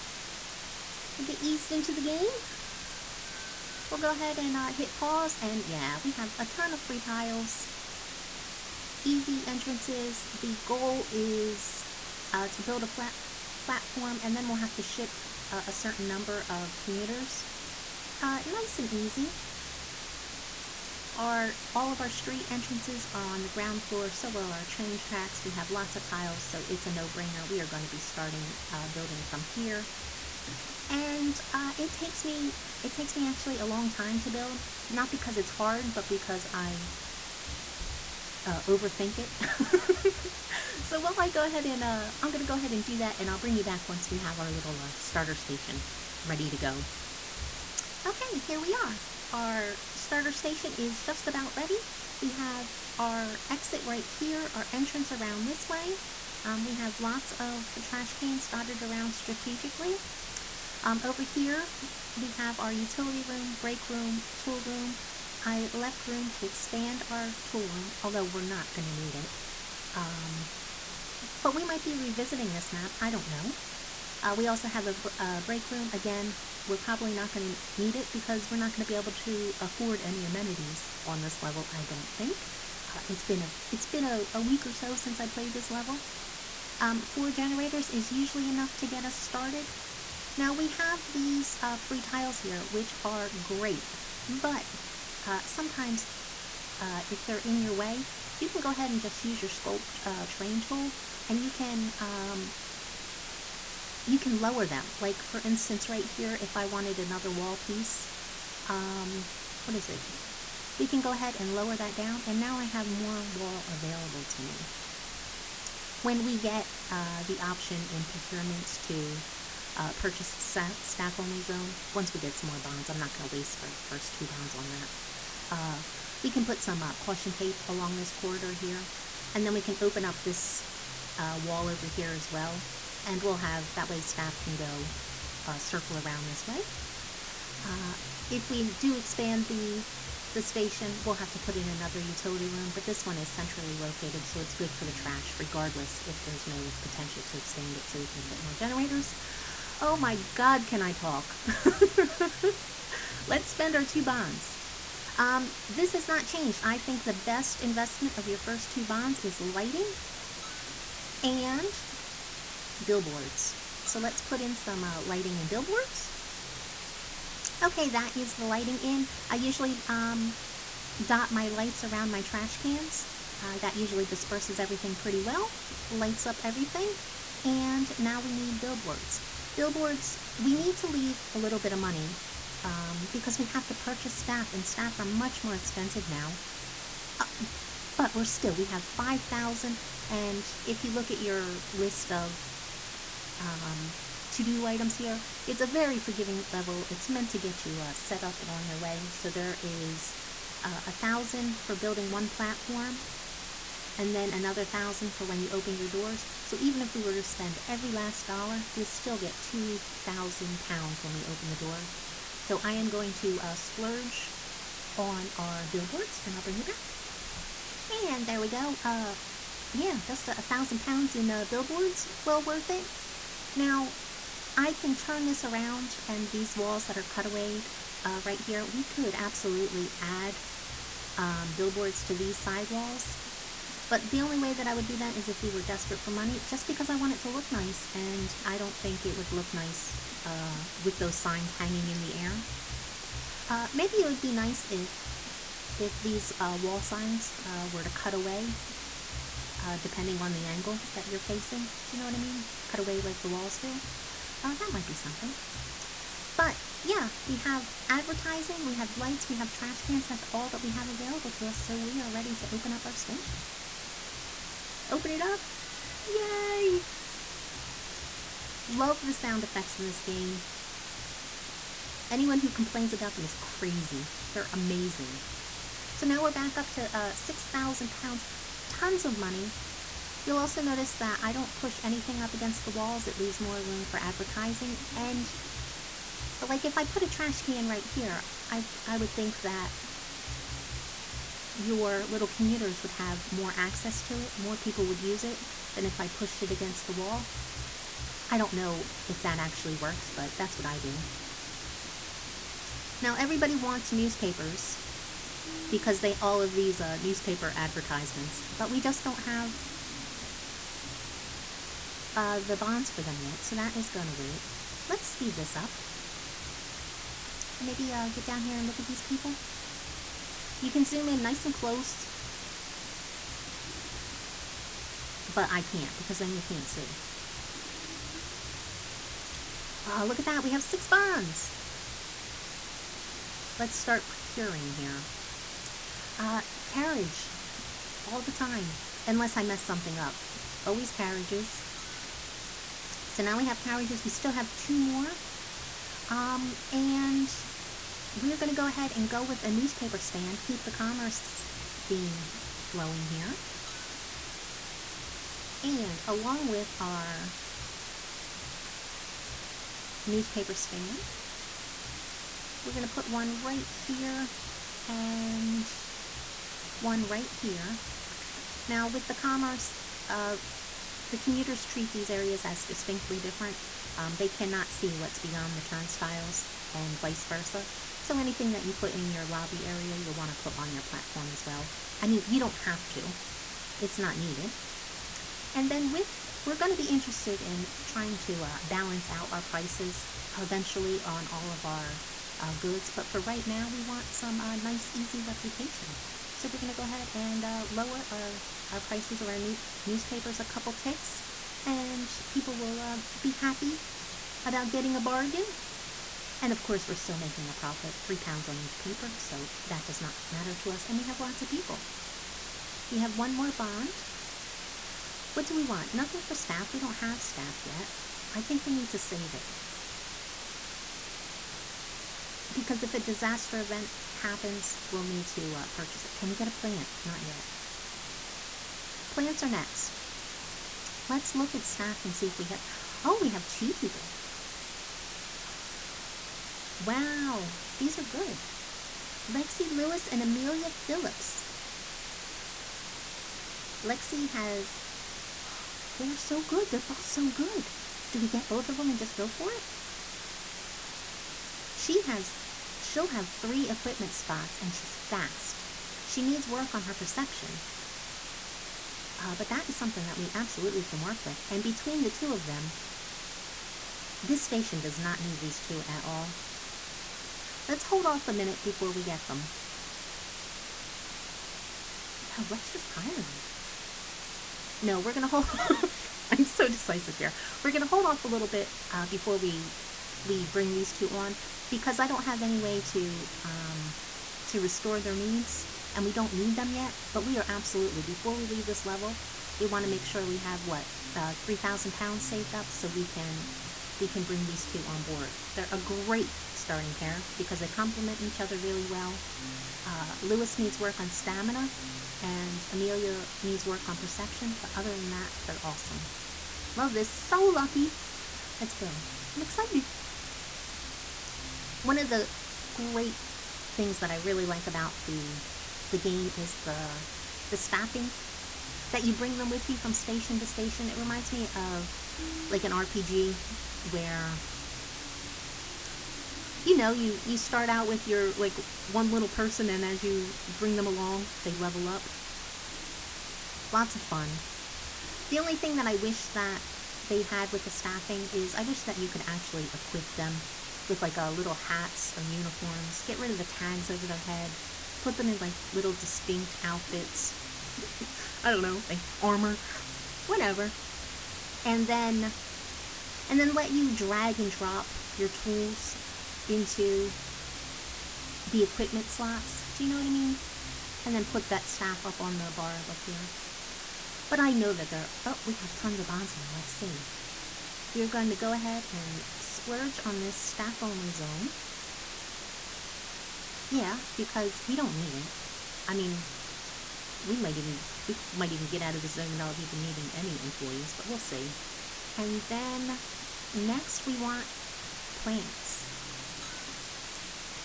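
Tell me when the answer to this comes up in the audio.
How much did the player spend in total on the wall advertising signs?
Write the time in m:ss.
3:40.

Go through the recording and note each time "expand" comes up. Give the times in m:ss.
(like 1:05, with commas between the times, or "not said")
1:06, 2:18, 2:27.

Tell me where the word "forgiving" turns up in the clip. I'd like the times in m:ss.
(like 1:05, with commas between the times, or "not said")
3:15.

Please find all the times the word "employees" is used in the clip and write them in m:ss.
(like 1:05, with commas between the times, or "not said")
9:40.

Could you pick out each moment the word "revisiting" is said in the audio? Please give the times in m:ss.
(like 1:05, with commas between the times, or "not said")
1:11.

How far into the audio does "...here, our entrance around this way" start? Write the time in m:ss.
0:54.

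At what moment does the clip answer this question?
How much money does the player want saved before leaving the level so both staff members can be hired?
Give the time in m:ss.
8:11.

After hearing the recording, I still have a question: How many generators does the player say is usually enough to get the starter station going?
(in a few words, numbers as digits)
4.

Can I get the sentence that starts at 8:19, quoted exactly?
Uh, Lewis needs work on stamina and Amelia needs work on perception, but other than that, they're awesome.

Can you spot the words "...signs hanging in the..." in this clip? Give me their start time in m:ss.
4:01.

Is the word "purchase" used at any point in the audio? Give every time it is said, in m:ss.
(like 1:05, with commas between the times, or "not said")
1:59, 3:03, 7:05.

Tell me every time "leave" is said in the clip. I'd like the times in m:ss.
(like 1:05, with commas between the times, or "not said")
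3:00, 4:43, 8:08.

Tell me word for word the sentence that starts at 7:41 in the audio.
And between the two of them, this station does not need these two at all.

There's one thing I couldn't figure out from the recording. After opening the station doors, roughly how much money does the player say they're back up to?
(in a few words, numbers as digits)
6,000 pounds.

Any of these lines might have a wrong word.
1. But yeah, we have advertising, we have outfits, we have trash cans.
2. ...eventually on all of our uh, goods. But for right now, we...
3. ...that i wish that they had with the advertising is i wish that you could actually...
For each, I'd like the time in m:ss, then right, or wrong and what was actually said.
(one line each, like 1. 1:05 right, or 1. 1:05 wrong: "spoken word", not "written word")
1. 4:16 wrong: "lights", not "outfits"
2. 6:30 right
3. 8:55 wrong: "staffing", not "advertising".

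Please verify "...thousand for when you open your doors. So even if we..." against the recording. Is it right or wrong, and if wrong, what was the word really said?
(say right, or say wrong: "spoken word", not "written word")
right.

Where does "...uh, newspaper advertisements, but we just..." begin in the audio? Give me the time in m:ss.
5:06.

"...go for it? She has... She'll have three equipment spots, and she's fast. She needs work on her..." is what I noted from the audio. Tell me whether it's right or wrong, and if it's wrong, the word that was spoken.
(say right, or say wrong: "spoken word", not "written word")
right.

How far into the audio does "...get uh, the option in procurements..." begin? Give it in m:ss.
1:56.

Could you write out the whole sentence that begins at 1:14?
Uh, we also have a, a, break room.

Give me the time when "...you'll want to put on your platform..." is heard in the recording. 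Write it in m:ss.
6:19.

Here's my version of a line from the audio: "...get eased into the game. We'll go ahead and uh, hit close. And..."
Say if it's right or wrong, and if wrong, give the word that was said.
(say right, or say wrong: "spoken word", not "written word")
wrong: "pause", not "close".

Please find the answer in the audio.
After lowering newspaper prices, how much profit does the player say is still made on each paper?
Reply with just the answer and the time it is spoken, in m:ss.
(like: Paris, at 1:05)
3 pounds, at 6:48.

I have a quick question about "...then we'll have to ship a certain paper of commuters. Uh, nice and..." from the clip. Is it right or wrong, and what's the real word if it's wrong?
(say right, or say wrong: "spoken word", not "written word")
wrong: "number", not "paper".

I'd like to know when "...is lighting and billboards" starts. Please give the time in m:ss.
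2:39.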